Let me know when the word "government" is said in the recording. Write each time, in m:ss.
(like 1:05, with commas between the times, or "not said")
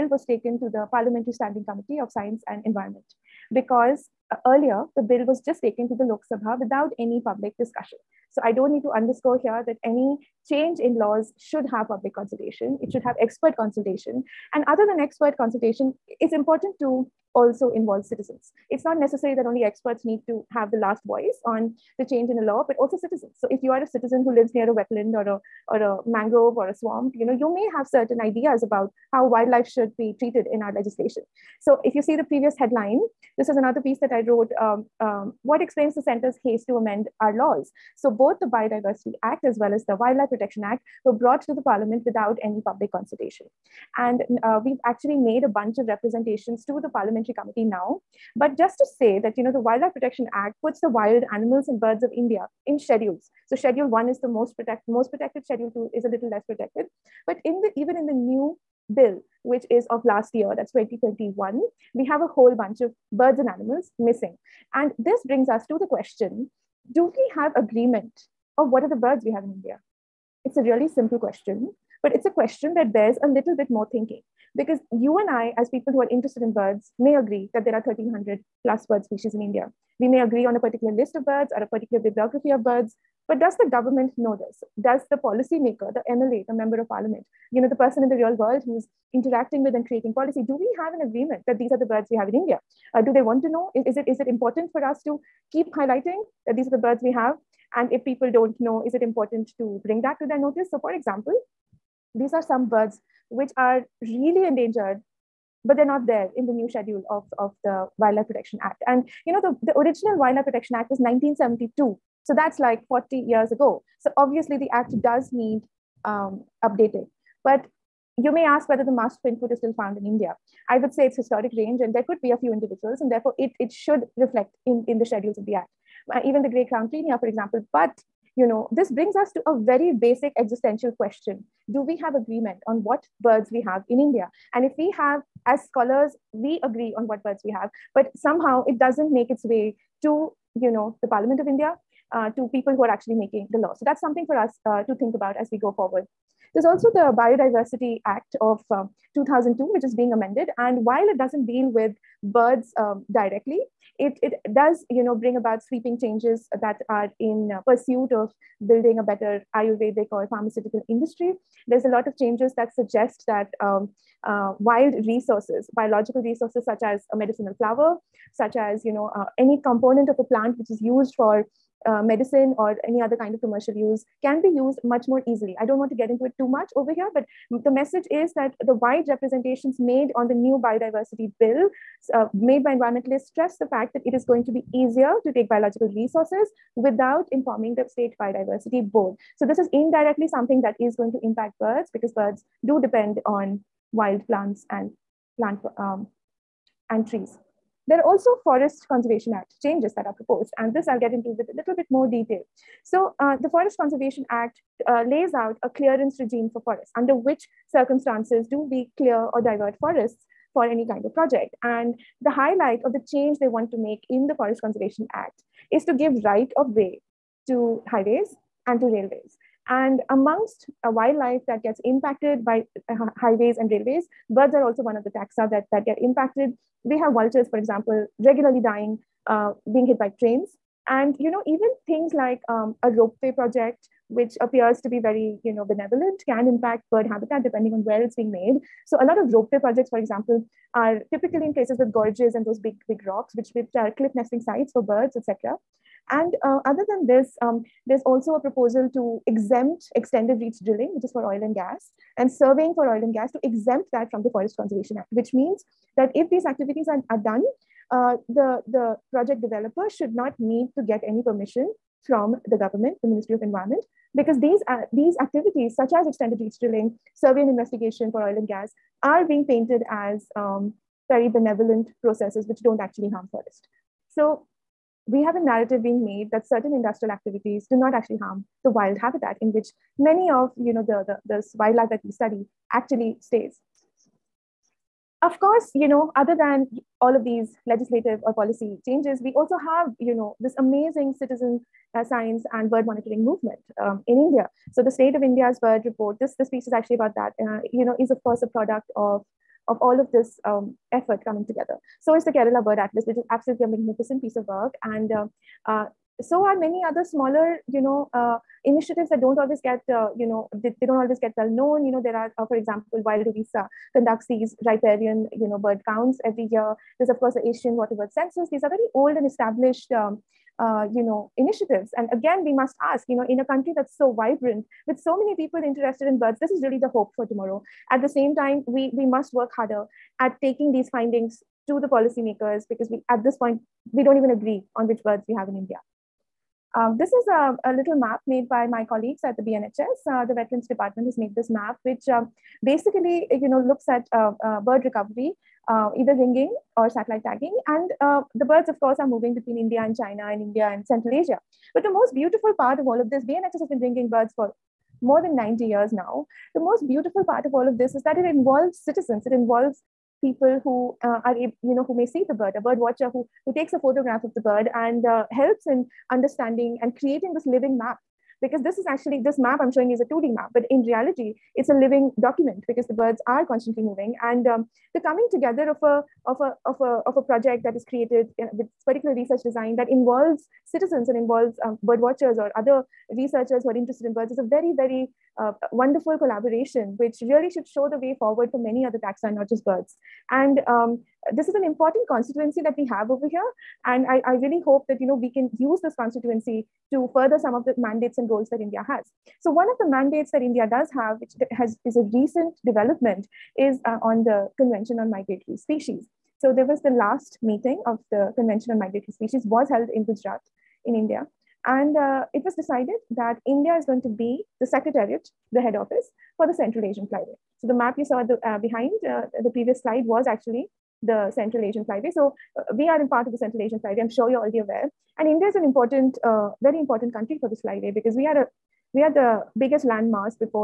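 1:23, 4:22.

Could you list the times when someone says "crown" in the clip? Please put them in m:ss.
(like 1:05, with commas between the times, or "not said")
2:06.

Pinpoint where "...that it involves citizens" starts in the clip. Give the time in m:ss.
5:58.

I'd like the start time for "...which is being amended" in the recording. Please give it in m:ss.
2:29.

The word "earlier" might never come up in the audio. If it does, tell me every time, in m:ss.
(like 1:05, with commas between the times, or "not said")
0:04.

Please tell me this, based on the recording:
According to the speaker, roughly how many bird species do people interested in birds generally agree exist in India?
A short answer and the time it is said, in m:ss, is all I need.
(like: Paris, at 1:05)
1,300 plus, at 1:17.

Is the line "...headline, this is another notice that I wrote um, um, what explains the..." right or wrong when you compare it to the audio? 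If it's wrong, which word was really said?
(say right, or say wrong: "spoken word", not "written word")
wrong: "piece", not "notice".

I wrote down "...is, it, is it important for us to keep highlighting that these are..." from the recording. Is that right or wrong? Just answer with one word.
right.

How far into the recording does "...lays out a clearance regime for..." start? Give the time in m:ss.
3:25.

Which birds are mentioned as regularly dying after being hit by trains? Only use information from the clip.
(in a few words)
Vultures.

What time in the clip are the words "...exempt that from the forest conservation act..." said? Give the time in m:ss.
4:13.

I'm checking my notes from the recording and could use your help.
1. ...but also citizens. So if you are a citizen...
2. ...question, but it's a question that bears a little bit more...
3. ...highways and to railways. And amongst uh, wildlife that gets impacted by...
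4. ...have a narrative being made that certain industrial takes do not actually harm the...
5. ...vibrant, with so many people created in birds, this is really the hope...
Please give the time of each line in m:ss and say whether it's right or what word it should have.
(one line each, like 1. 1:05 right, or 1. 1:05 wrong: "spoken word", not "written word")
1. 0:22 right
2. 1:11 right
3. 3:37 right
4. 4:35 wrong: "activities", not "takes"
5. 5:24 wrong: "interested", not "created".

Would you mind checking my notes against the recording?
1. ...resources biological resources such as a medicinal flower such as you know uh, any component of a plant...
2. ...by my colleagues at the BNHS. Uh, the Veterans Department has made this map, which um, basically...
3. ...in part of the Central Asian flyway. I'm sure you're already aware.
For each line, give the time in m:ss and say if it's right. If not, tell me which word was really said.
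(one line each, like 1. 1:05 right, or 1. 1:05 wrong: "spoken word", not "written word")
1. 2:45 right
2. 5:38 right
3. 7:02 right.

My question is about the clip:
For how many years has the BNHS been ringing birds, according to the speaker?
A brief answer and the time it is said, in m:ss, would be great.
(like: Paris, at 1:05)
More than 90 years, at 5:55.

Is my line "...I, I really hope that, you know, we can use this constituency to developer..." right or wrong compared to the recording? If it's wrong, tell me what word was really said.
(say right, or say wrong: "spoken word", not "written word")
wrong: "further", not "developer".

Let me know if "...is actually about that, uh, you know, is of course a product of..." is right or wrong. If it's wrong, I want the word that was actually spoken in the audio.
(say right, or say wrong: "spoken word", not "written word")
right.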